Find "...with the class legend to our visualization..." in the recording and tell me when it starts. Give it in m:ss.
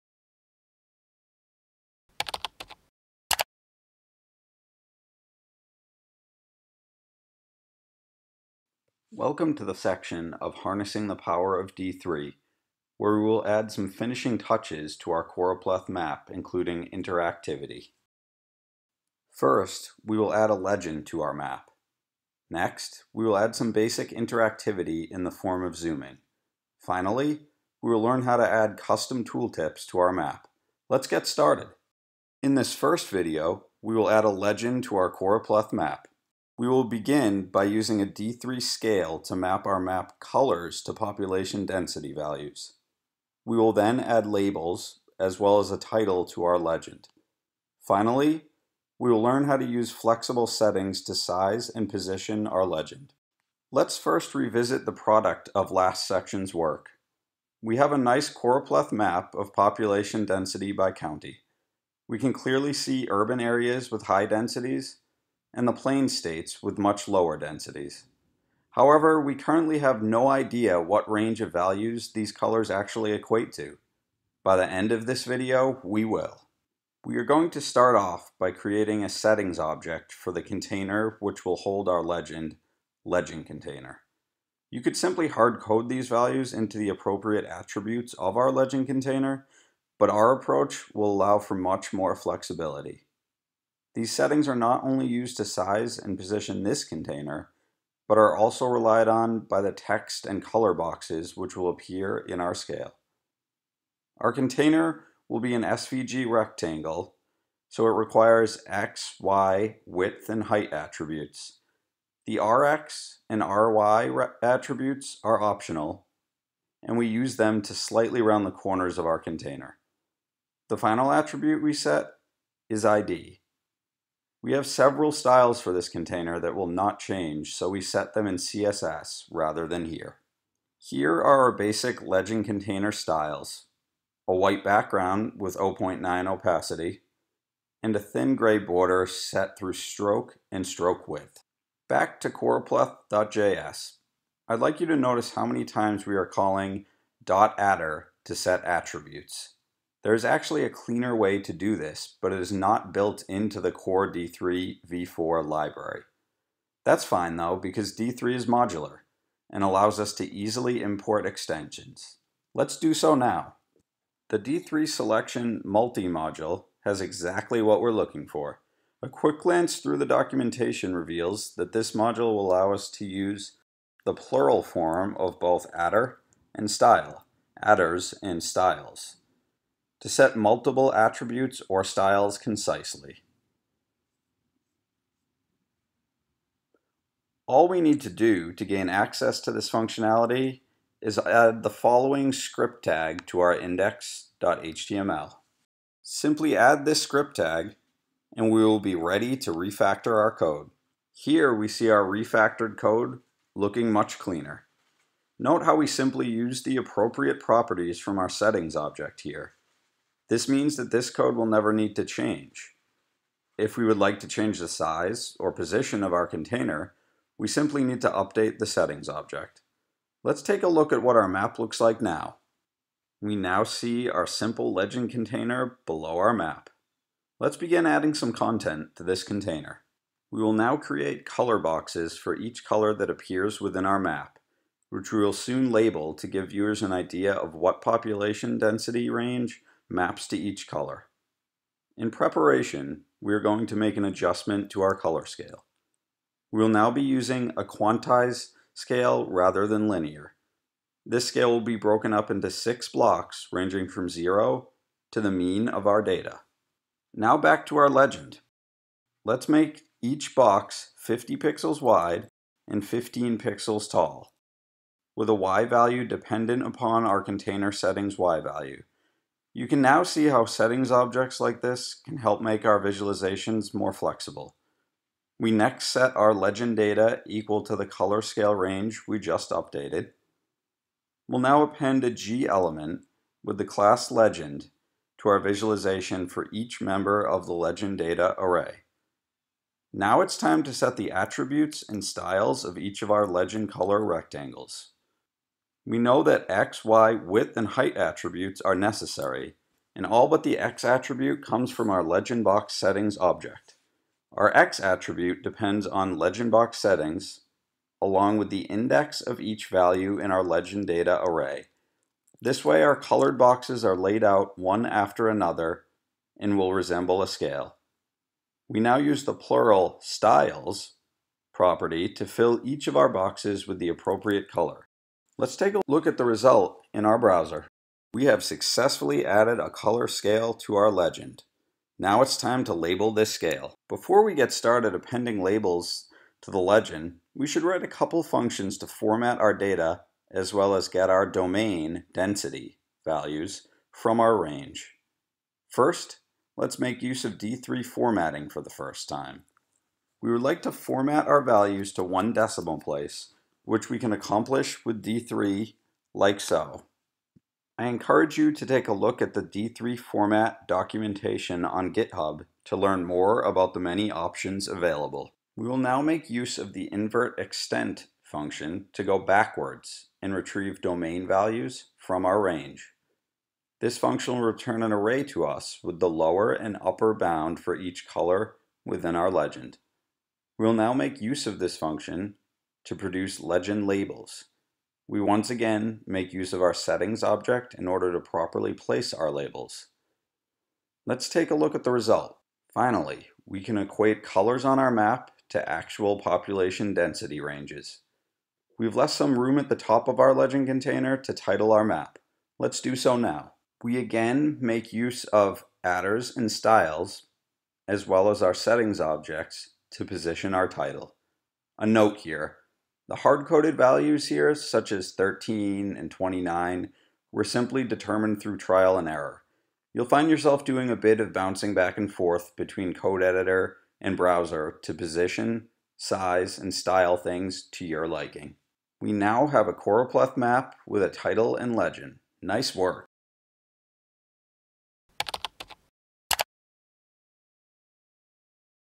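4:43.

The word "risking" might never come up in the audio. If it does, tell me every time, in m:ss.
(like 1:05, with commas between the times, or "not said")
not said.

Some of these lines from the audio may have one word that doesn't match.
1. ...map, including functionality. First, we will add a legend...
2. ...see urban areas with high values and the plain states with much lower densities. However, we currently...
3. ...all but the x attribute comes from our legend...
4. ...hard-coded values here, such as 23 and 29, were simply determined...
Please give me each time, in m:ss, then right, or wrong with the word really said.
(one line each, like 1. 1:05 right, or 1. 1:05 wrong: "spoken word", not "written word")
1. 0:15 wrong: "interactivity", not "functionality"
2. 1:02 wrong: "densities", not "values"
3. 5:00 right
4. 6:53 wrong: "13", not "23".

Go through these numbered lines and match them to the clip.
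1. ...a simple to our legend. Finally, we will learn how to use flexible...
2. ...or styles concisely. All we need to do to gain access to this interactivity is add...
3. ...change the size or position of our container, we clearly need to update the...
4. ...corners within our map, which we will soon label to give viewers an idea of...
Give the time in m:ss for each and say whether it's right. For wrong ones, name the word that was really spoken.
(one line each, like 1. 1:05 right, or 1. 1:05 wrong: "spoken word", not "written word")
1. 0:45 wrong: "title", not "simple"
2. 3:01 wrong: "functionality", not "interactivity"
3. 3:34 wrong: "simply", not "clearly"
4. 3:53 wrong: "appears", not "corners".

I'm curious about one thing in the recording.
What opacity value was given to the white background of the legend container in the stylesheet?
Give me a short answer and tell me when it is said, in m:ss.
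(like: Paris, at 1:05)
0.9, at 2:15.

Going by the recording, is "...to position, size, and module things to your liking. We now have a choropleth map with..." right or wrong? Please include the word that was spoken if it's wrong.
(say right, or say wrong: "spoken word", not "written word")
wrong: "style", not "module".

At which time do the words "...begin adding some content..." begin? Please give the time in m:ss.
3:47.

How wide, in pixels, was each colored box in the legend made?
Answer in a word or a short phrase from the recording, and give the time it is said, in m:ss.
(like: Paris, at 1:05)
50 pixels, at 4:20.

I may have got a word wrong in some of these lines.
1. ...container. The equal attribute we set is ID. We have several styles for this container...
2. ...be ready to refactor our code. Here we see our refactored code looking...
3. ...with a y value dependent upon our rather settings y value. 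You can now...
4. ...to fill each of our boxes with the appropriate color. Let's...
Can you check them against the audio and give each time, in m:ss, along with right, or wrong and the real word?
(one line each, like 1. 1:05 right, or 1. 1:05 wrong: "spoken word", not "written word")
1. 1:59 wrong: "final", not "equal"
2. 3:18 right
3. 4:25 wrong: "container", not "rather"
4. 5:22 right.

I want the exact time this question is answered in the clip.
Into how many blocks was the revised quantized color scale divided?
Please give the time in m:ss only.
4:12.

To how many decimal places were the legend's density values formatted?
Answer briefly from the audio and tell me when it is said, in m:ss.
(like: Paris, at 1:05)
1, at 5:52.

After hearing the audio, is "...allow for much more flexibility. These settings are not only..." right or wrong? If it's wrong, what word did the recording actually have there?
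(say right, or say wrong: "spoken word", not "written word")
right.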